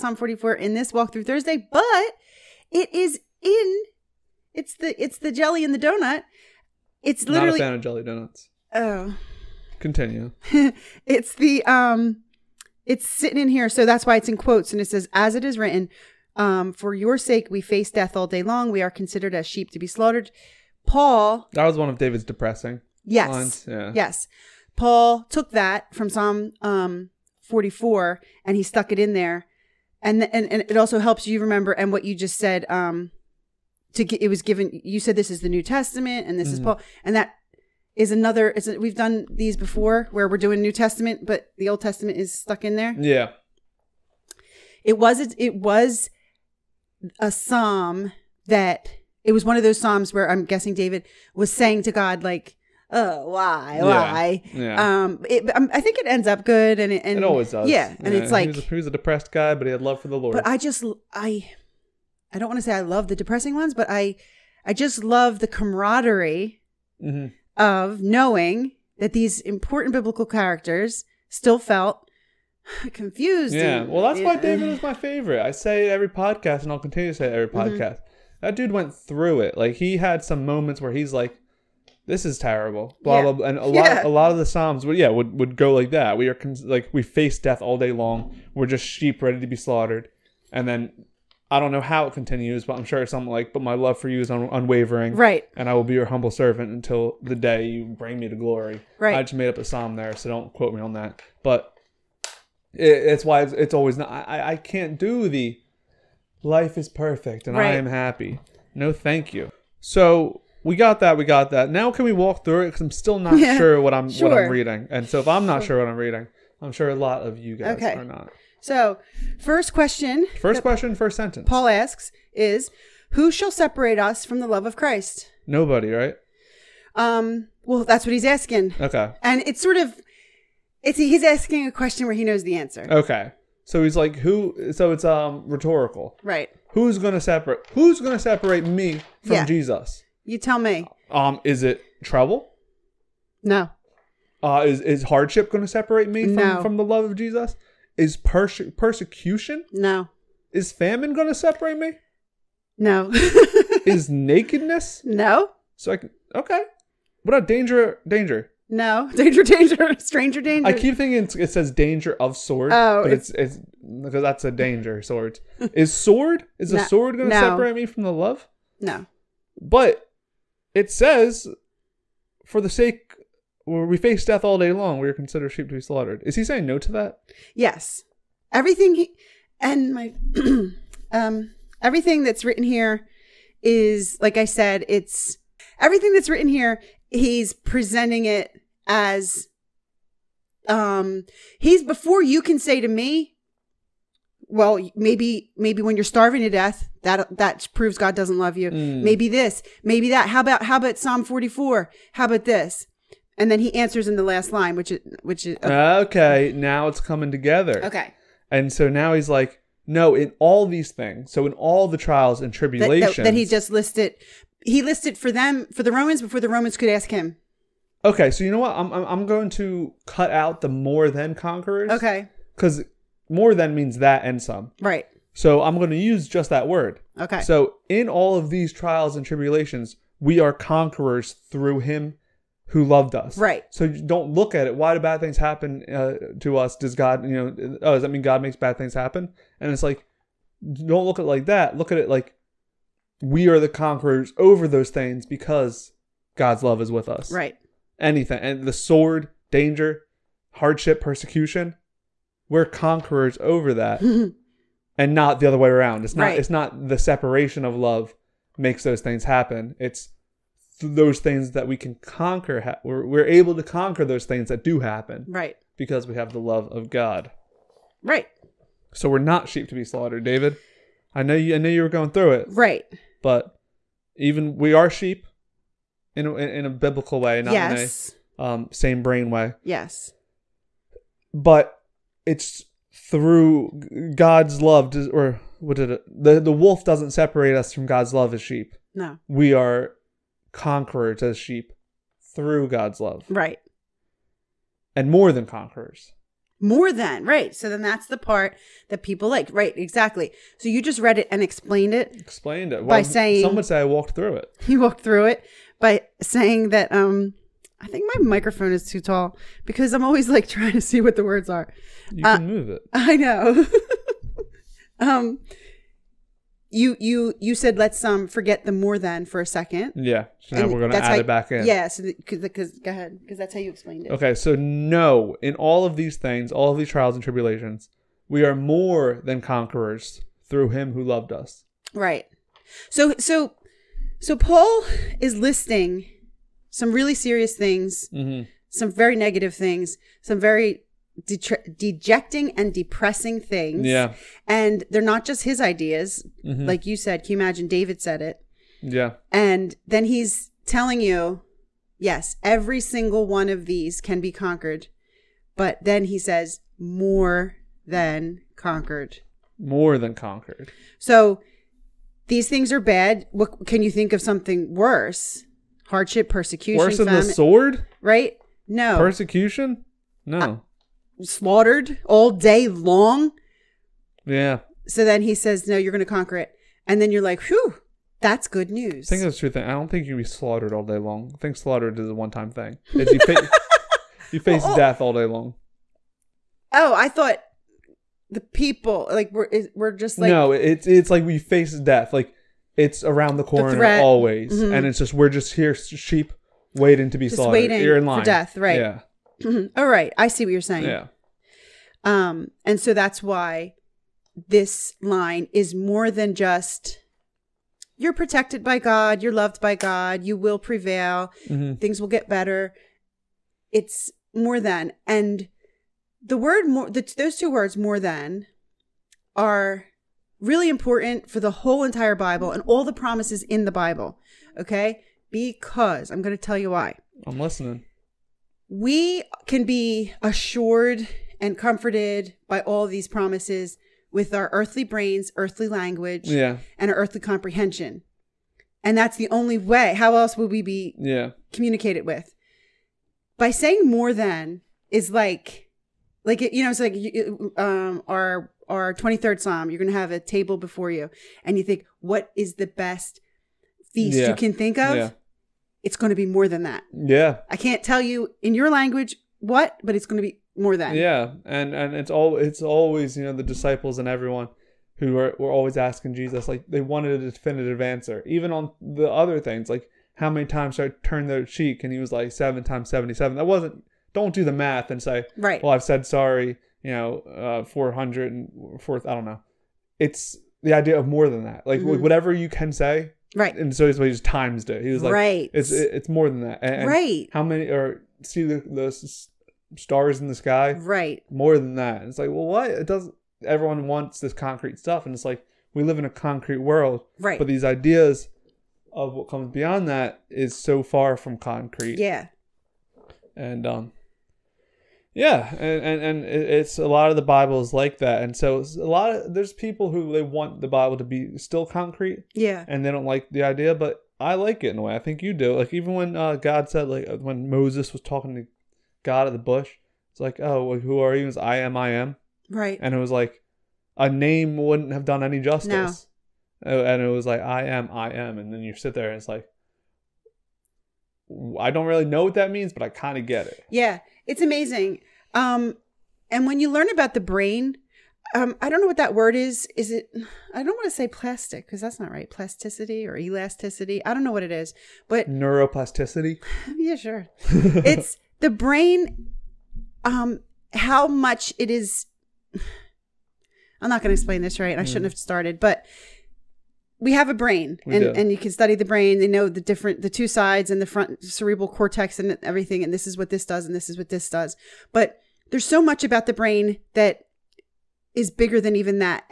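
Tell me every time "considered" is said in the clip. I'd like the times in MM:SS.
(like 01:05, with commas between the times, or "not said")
00:18, 02:55.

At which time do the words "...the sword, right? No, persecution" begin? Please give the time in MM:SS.
06:07.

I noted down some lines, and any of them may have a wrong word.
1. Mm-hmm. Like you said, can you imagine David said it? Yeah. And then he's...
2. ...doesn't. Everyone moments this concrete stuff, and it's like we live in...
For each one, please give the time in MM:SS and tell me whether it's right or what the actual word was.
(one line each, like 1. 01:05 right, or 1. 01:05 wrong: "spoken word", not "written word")
1. 05:46 right
2. 08:12 wrong: "wants", not "moments".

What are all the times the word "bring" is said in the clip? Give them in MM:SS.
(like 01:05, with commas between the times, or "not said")
01:37.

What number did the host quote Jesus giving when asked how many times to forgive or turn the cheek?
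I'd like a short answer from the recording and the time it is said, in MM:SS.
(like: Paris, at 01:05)
7 times 77, at 07:52.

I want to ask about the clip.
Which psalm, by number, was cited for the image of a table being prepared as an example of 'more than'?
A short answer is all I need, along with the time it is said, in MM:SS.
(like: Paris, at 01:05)
23rd psalm, at 07:28.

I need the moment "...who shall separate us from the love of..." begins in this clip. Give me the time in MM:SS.
02:03.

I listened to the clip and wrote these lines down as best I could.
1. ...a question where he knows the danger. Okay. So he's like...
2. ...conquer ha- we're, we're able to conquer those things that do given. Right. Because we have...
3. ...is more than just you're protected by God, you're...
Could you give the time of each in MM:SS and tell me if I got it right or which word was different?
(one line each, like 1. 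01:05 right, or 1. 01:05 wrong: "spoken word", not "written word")
1. 02:11 wrong: "answer", not "danger"
2. 04:21 wrong: "happen", not "given"
3. 06:45 right.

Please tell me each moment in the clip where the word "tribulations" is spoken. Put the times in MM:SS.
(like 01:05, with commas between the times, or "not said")
03:32, 03:49, 05:27.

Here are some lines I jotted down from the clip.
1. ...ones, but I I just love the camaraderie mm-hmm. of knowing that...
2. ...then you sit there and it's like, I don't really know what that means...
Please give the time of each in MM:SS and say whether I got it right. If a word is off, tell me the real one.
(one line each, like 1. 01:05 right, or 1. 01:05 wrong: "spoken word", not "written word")
1. 01:03 right
2. 08:48 right.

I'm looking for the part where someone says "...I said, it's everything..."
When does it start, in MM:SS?
03:04.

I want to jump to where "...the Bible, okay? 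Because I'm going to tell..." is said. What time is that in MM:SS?
07:03.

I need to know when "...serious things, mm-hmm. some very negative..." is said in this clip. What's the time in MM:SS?
05:37.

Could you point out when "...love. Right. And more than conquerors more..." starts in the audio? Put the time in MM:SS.
04:52.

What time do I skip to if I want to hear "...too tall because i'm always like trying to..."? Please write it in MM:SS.
05:08.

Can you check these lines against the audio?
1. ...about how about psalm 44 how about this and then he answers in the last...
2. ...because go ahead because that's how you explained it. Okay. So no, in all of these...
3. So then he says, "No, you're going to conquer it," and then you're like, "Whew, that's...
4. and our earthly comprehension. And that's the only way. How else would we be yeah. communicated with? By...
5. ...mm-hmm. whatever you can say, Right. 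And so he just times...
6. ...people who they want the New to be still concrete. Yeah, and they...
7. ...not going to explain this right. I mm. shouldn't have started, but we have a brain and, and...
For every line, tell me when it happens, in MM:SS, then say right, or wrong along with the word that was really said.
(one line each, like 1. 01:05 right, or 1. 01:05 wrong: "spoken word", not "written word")
1. 03:20 right
2. 05:22 right
3. 06:14 right
4. 07:16 right
5. 08:01 right
6. 08:29 wrong: "Bible", not "New"
7. 09:13 right.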